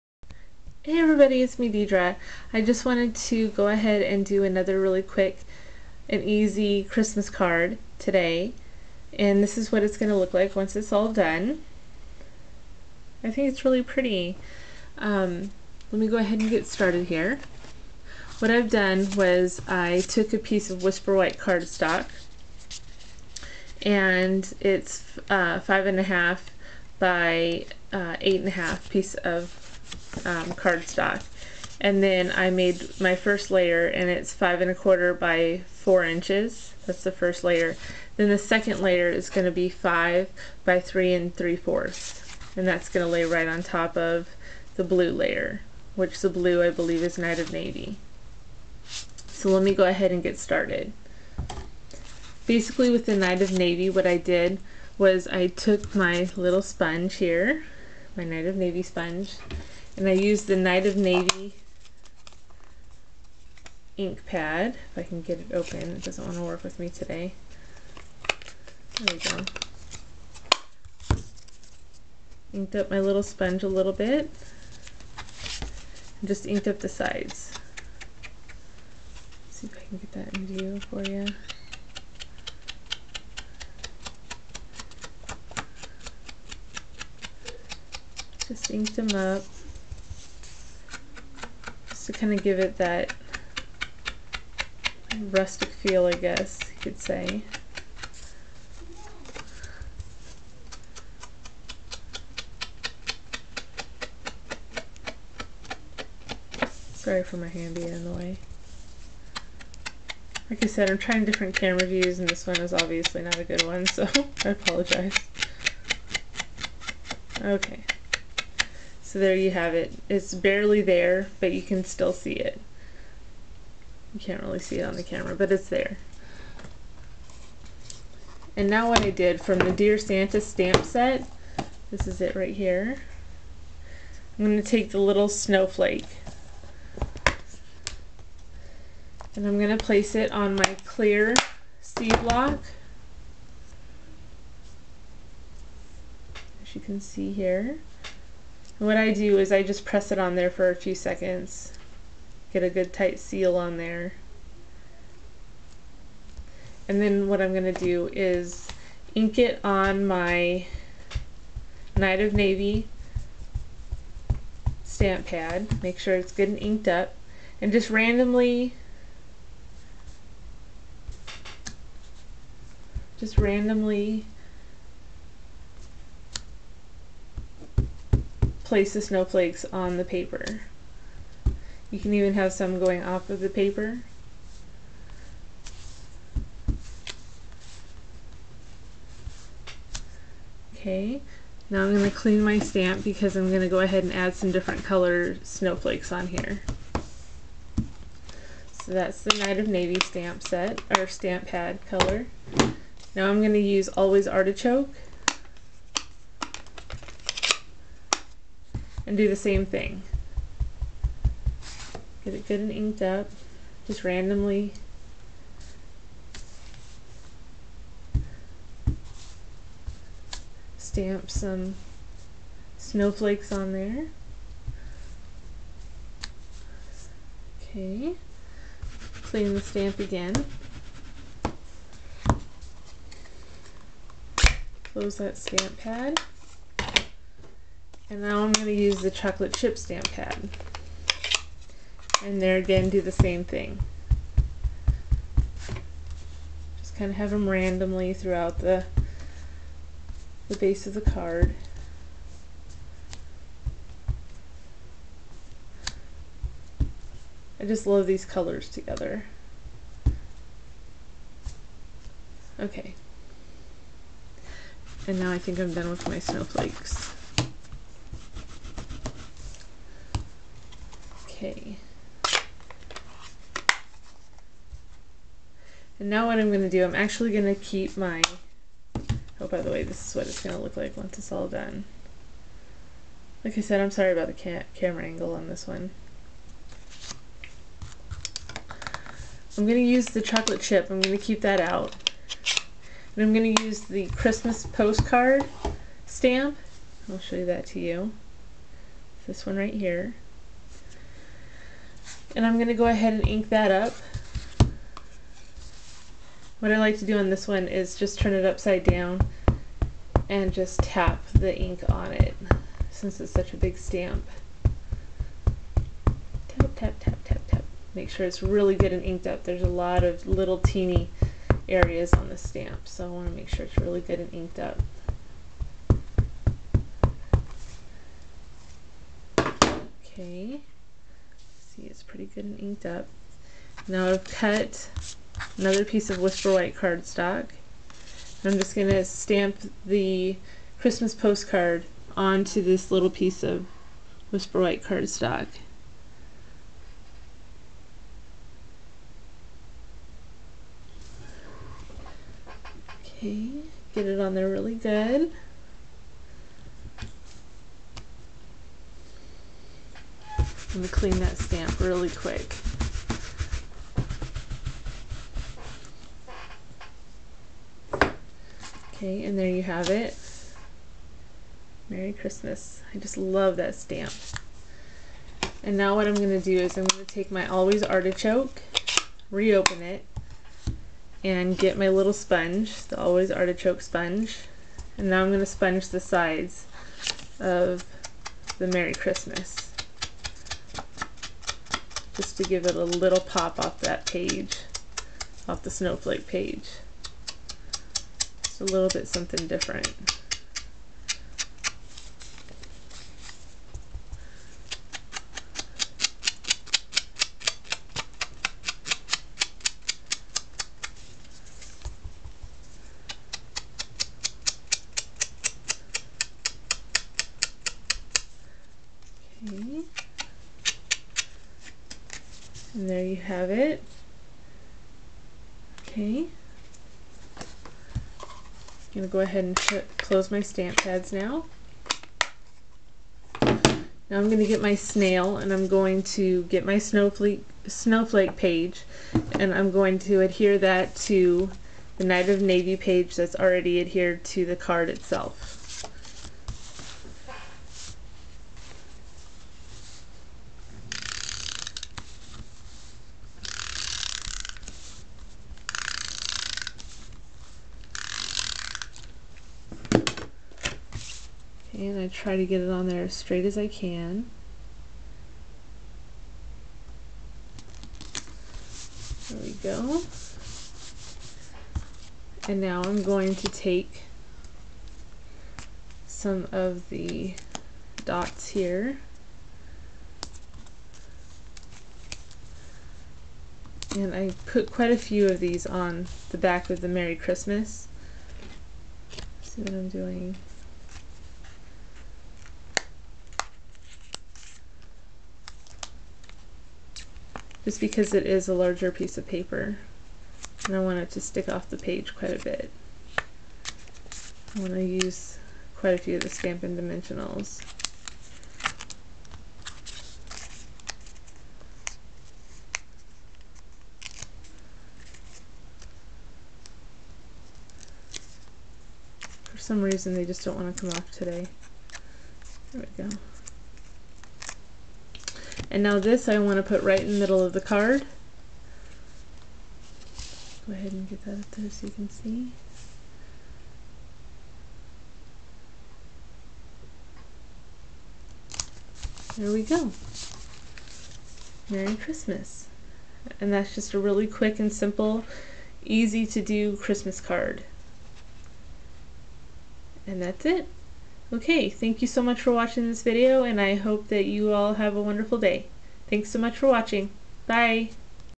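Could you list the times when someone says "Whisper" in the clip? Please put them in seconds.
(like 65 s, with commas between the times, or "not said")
20 s, 336 s, 344 s.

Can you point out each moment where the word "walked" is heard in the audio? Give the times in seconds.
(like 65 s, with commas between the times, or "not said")
not said.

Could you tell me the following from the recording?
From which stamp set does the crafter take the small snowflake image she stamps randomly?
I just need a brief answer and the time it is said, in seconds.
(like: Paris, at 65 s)
Dear Santa, at 129 s.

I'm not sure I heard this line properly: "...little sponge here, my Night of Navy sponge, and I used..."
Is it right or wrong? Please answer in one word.
right.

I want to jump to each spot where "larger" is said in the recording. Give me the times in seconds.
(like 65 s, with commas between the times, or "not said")
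498 s.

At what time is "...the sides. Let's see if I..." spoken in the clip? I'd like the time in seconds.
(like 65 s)
76 s.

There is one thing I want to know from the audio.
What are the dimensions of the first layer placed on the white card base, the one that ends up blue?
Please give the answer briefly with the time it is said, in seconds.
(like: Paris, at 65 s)
5 1/4 by 4 inches, at 34 s.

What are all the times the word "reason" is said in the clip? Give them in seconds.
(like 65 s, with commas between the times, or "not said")
519 s.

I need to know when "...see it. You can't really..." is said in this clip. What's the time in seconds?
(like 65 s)
122 s.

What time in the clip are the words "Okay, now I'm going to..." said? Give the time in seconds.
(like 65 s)
190 s.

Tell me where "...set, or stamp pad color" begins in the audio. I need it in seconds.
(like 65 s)
200 s.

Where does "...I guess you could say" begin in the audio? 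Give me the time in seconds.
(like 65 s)
96 s.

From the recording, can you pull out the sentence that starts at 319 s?
There's a lot of little teeny areas on the stamp, so I want to make sure it's really good and inked up.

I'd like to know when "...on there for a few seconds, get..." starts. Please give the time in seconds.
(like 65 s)
150 s.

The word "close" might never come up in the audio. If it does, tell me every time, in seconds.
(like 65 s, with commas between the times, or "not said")
234 s, 429 s.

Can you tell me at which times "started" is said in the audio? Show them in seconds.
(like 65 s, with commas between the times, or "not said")
16 s, 50 s.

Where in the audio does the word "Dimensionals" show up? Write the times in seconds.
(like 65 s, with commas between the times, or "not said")
506 s.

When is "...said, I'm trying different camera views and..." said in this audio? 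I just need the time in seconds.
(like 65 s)
110 s.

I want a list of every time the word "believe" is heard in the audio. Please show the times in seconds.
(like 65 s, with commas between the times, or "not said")
46 s.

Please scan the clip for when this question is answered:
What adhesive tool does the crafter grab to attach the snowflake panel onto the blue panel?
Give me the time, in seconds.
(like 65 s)
434 s.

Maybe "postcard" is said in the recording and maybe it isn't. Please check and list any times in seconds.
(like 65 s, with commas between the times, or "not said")
294 s, 341 s.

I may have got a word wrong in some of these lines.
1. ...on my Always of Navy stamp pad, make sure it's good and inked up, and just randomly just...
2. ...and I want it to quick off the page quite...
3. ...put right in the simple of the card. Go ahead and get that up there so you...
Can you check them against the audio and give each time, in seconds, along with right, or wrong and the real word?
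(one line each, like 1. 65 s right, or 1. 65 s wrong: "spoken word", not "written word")
1. 159 s wrong: "Night", not "Always"
2. 500 s wrong: "stick", not "quick"
3. 526 s wrong: "middle", not "simple".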